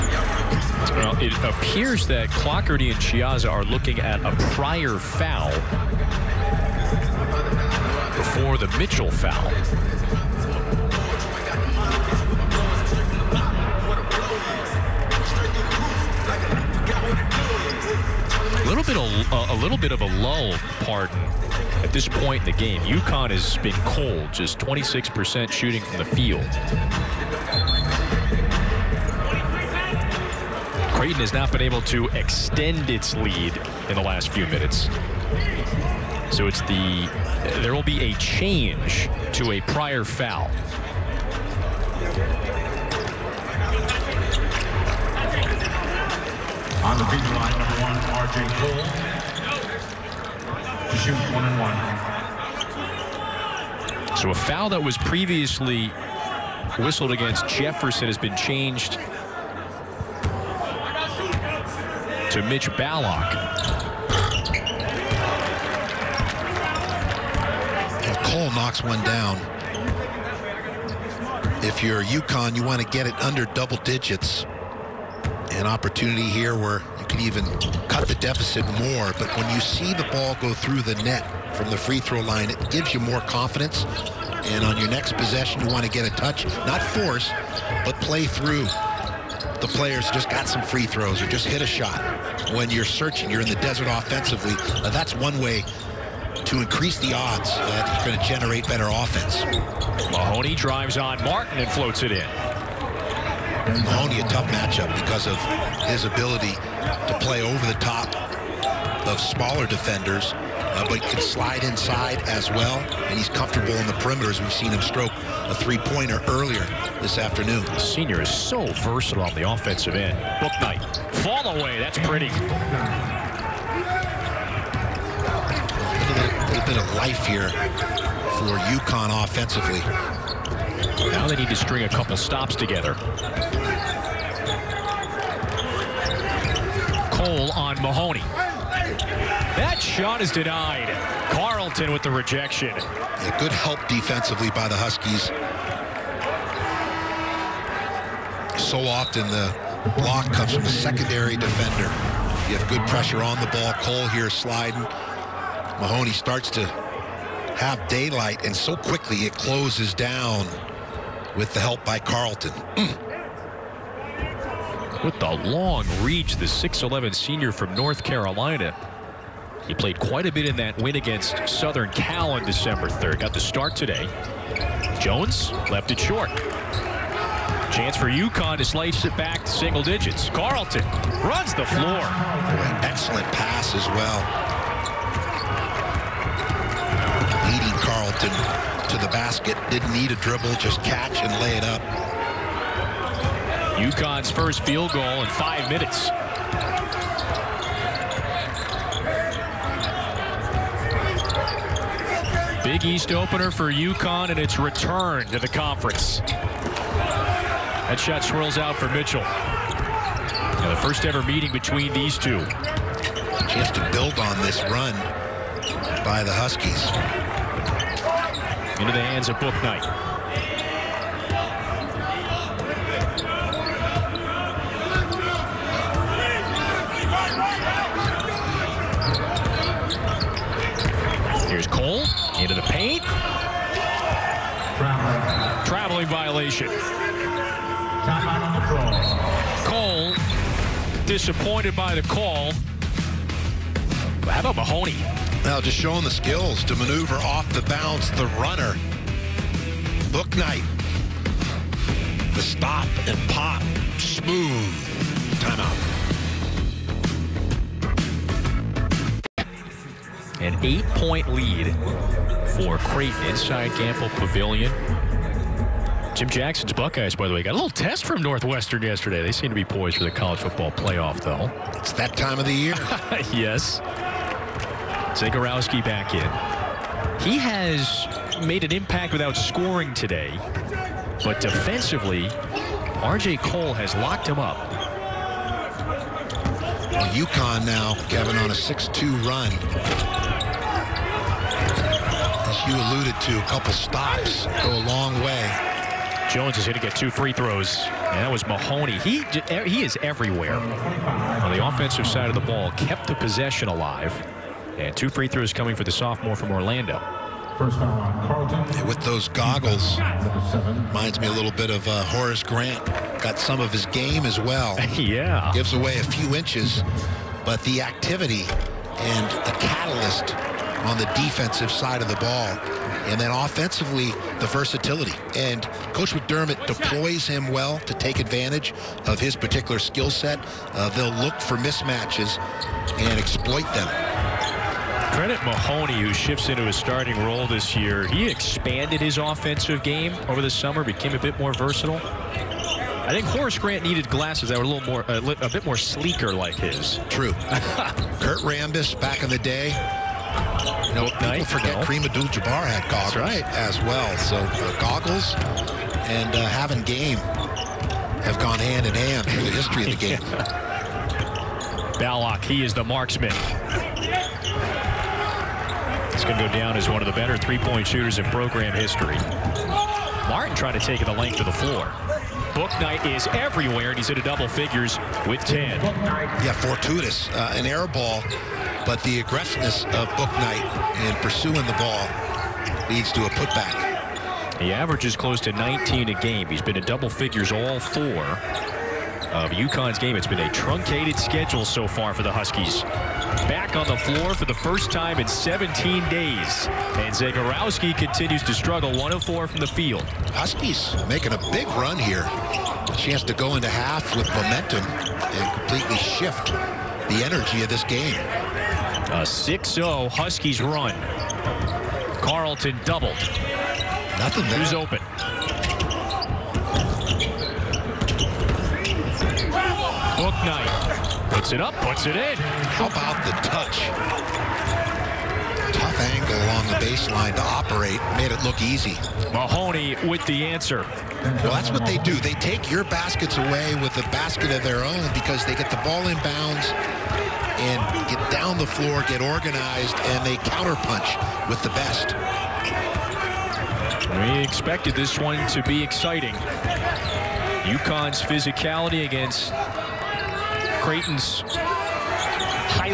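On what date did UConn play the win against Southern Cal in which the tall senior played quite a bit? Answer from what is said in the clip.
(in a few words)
December 3.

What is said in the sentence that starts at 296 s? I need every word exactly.
Jones is going to get two free throws.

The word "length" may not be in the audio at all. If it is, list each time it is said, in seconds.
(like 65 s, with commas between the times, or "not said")
371 s.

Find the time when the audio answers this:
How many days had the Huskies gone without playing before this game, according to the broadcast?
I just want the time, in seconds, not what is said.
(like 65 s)
395 s.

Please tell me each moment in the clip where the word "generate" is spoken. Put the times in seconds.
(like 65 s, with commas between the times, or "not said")
98 s.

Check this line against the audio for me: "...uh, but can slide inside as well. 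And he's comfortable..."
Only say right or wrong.
right.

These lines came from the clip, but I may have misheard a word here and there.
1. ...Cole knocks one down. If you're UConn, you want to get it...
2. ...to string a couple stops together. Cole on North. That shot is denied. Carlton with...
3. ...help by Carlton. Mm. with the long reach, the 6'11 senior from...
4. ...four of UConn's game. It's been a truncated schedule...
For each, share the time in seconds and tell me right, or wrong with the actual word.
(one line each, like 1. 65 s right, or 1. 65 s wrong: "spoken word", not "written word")
1. 68 s right
2. 131 s wrong: "Mahoney", not "North"
3. 161 s right
4. 387 s right.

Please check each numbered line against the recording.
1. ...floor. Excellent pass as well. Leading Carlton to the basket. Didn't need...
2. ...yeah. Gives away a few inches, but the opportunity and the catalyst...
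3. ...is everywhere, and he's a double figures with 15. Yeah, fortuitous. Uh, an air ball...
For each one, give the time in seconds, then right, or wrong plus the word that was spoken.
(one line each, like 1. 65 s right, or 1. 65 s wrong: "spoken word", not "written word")
1. 181 s right
2. 314 s wrong: "activity", not "opportunity"
3. 373 s wrong: "10", not "15".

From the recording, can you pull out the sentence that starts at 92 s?
When you're searching, you're in the desert offensively.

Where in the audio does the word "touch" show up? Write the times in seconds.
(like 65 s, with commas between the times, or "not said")
86 s, 423 s.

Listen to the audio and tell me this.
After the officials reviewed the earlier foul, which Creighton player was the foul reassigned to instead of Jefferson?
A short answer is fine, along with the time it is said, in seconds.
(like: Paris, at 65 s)
Mitch Ballock, at 62 s.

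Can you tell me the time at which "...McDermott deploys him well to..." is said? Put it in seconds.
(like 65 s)
326 s.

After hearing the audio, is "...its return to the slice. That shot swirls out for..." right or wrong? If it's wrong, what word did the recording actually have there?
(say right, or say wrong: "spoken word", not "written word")
wrong: "conference", not "slice".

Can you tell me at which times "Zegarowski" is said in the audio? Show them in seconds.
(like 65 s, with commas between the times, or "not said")
275 s, 397 s.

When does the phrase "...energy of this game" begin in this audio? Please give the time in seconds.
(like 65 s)
407 s.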